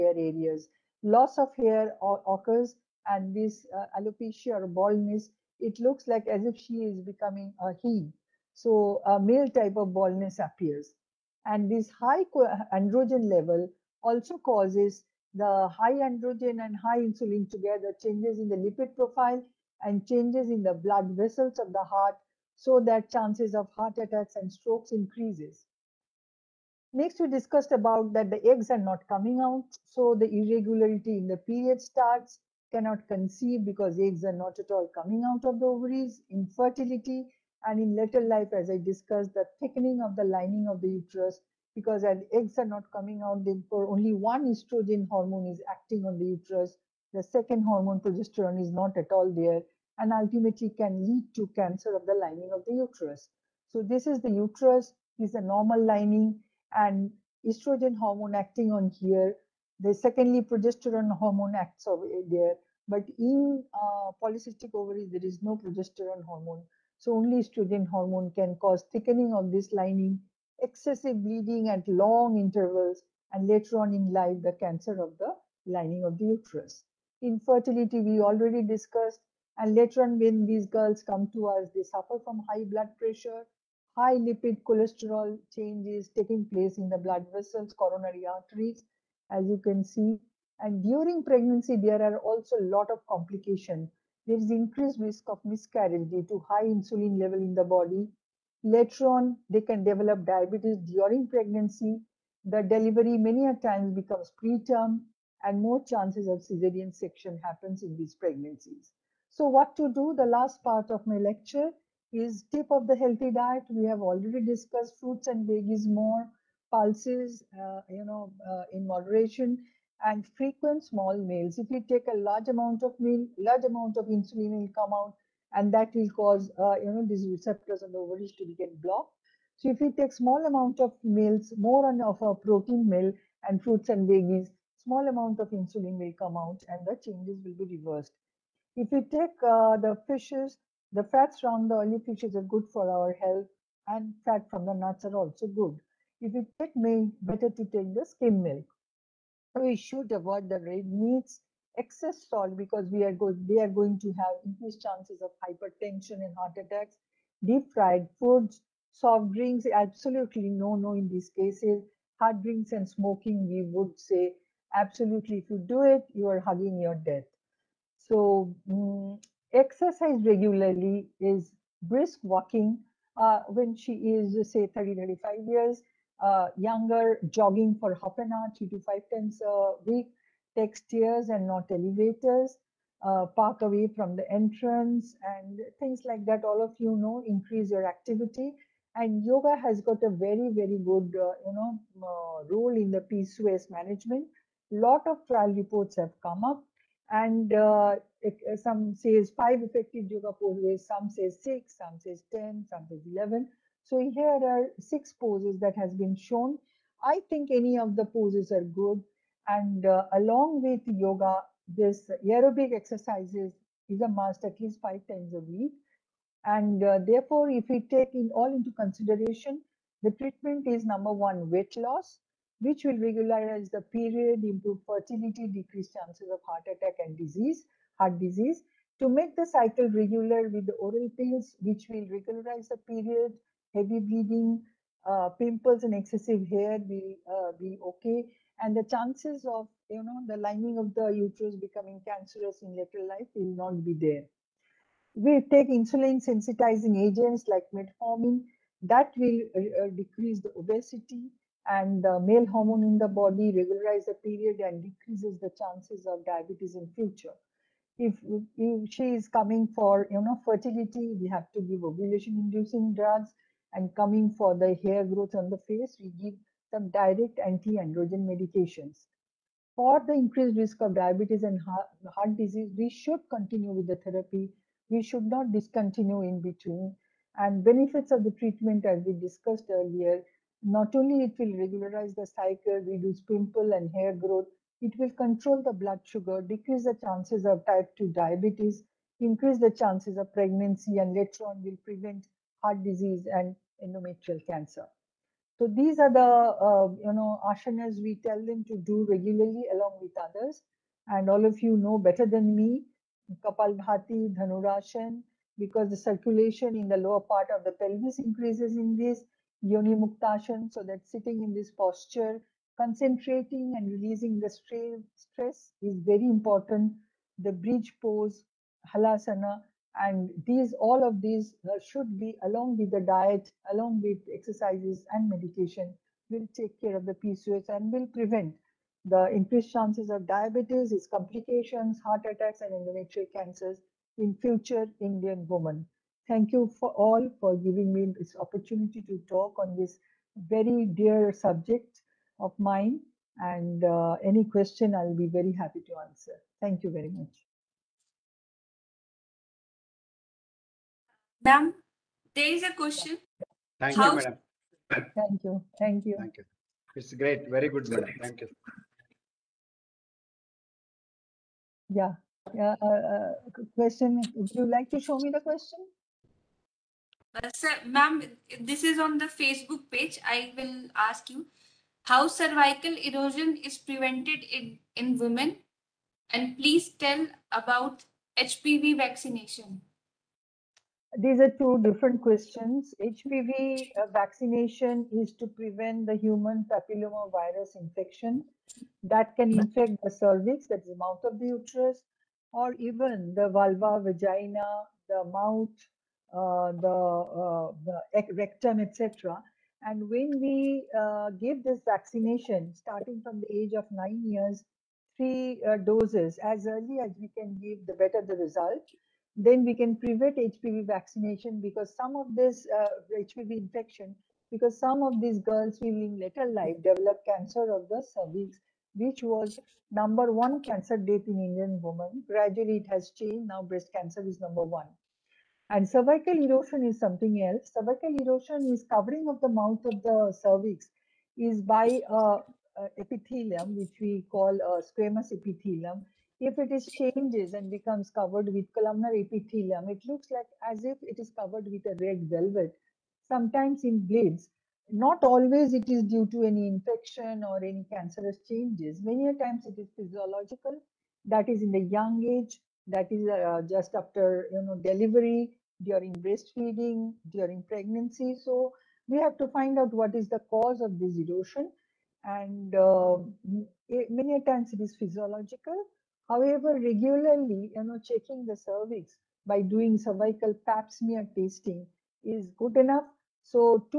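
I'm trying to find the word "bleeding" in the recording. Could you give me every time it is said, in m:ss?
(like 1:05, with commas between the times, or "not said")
1:11, 3:53.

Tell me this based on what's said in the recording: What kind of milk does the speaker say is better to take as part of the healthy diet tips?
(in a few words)
Skim milk.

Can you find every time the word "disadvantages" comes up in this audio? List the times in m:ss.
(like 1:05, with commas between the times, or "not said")
not said.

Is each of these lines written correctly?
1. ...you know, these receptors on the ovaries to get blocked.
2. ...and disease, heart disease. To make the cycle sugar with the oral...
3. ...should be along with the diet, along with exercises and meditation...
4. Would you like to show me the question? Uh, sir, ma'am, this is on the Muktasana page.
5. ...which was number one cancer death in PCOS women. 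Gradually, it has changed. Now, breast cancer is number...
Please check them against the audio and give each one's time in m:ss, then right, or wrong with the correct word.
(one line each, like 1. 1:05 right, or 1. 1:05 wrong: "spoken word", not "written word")
1. 2:06 right
2. 3:47 wrong: "regular", not "sugar"
3. 5:21 right
4. 6:04 wrong: "Facebook", not "Muktasana"
5. 6:58 wrong: "Indian", not "PCOS".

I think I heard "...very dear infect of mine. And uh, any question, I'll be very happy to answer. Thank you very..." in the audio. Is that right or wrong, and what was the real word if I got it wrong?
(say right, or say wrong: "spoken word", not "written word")
wrong: "subject", not "infect".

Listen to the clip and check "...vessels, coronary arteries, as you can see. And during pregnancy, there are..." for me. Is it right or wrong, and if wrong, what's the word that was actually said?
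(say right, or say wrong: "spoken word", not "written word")
right.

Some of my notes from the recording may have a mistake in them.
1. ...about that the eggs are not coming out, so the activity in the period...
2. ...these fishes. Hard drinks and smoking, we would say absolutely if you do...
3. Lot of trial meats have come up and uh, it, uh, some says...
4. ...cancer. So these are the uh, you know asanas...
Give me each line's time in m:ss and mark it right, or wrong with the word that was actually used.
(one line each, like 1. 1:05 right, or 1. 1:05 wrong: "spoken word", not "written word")
1. 0:27 wrong: "irregularity", not "activity"
2. 2:41 wrong: "cases", not "fishes"
3. 3:14 wrong: "reports", not "meats"
4. 4:54 right.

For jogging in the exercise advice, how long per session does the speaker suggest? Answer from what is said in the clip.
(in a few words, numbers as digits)
Half an hour.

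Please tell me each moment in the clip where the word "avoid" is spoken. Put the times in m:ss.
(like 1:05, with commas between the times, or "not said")
2:30.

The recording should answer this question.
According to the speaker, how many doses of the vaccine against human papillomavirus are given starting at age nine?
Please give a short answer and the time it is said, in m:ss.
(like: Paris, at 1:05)
3, at 6:45.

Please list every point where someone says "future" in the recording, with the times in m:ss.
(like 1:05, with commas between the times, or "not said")
4:16, 5:34.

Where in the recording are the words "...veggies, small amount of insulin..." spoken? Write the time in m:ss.
2:14.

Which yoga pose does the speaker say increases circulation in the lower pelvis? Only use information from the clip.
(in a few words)
Dhanurasana.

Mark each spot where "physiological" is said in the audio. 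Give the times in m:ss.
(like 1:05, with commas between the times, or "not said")
7:29, 7:44.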